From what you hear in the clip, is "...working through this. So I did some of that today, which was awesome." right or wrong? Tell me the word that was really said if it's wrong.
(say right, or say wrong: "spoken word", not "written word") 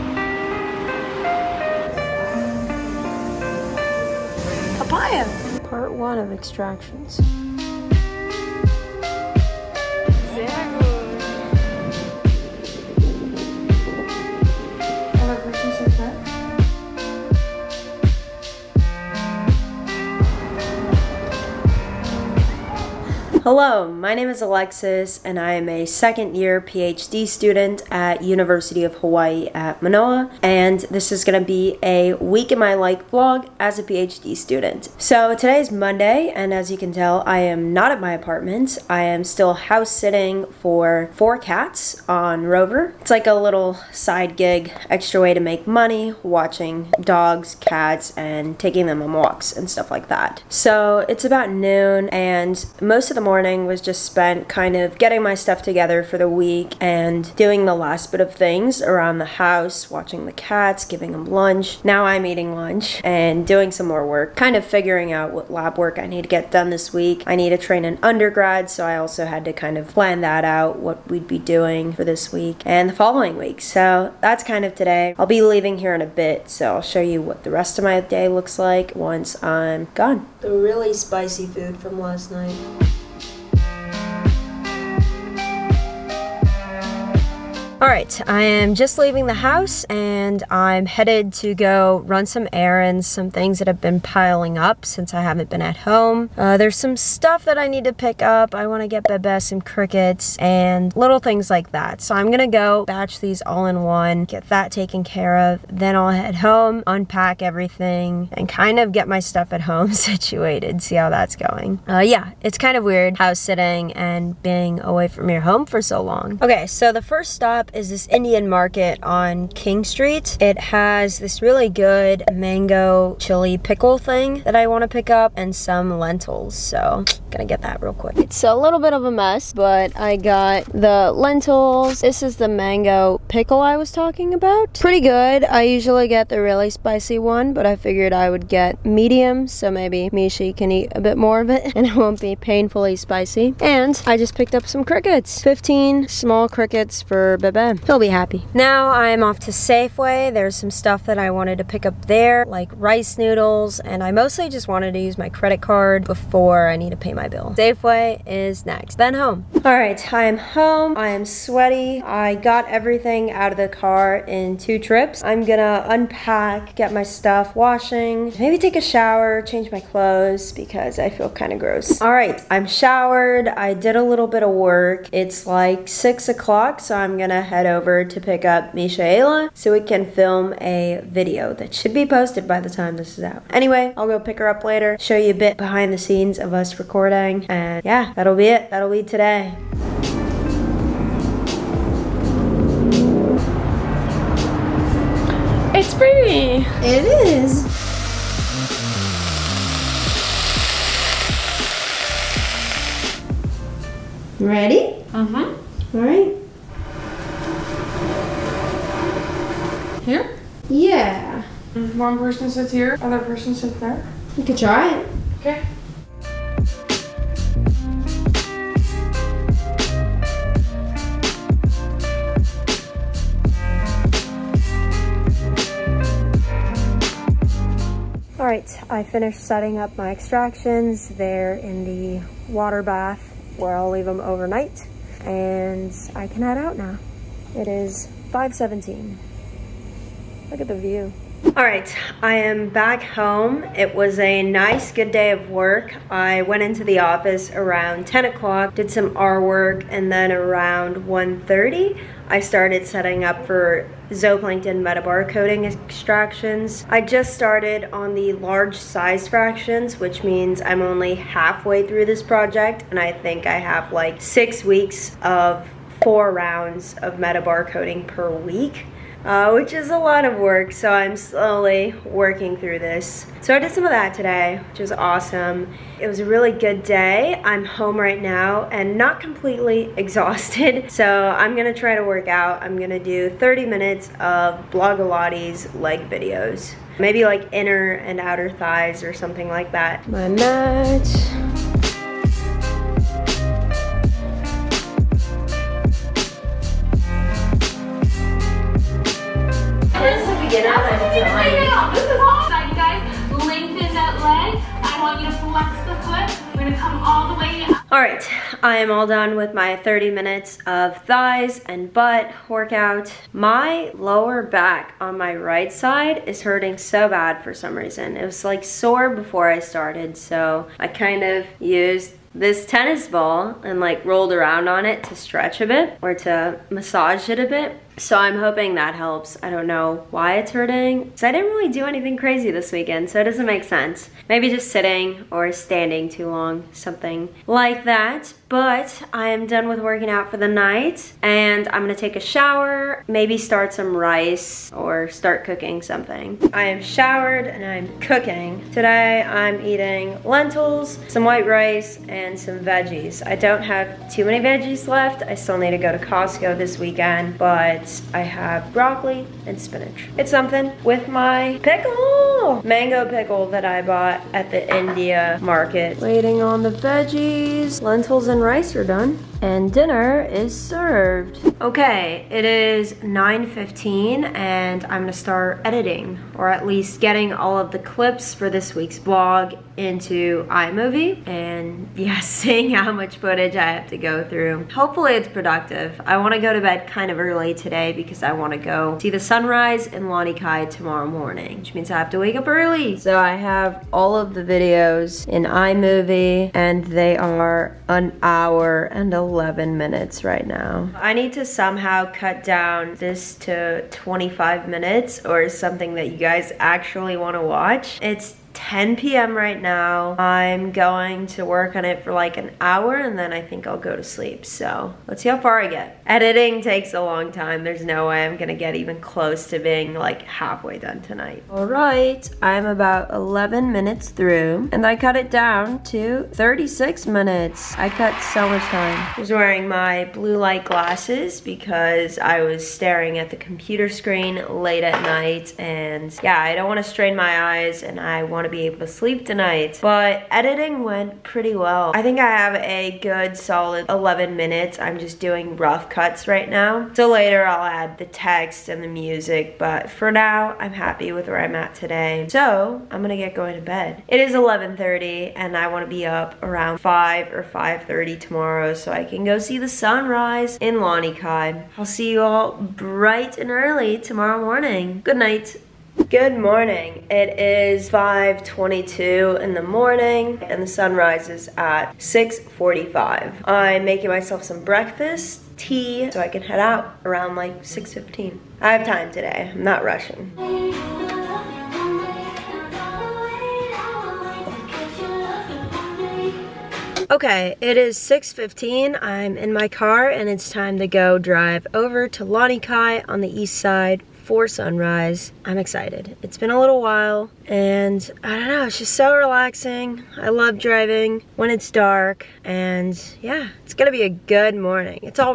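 right.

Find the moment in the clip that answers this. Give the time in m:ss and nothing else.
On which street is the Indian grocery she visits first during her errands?
1:59.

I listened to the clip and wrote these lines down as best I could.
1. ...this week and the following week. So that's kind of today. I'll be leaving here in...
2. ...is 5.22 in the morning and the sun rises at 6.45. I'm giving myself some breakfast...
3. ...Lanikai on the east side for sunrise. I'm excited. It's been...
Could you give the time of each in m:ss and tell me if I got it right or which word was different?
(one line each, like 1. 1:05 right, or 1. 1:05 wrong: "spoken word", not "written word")
1. 1:12 right
2. 7:47 wrong: "making", not "giving"
3. 8:12 right.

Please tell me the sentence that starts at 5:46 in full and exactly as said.
I am showered and I'm cooking.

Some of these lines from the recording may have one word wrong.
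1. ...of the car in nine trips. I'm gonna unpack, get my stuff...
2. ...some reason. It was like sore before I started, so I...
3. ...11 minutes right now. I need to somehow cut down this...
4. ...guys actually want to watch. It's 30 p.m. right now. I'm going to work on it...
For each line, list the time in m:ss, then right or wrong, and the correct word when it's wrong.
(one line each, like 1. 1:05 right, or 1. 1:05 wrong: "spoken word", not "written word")
1. 2:43 wrong: "two", not "nine"
2. 5:17 right
3. 6:39 right
4. 6:46 wrong: "10", not "30".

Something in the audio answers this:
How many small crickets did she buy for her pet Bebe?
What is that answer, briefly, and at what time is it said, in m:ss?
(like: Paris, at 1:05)
15, at 2:25.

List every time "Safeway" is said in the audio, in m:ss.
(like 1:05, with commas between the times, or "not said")
2:29, 2:37.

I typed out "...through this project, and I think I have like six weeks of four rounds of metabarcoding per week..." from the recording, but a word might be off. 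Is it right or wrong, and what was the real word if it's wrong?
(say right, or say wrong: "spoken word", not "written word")
right.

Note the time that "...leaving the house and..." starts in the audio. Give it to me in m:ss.
1:28.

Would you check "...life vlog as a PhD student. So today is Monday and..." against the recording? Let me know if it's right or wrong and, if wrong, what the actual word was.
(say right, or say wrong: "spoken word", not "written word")
right.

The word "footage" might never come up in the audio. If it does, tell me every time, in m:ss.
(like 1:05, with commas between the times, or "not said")
6:23.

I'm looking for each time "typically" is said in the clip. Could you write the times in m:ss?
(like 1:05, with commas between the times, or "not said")
not said.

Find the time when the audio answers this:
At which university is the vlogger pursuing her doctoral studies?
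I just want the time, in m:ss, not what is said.
0:28.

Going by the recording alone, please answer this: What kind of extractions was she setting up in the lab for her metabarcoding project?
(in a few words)
Zooplankton.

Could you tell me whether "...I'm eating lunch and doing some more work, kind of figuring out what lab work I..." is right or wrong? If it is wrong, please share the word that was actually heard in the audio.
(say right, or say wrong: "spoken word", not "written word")
right.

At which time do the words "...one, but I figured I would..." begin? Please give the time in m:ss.
2:17.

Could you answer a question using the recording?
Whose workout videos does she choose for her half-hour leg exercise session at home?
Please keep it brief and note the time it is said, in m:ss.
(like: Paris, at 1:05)
Blogilates, at 4:44.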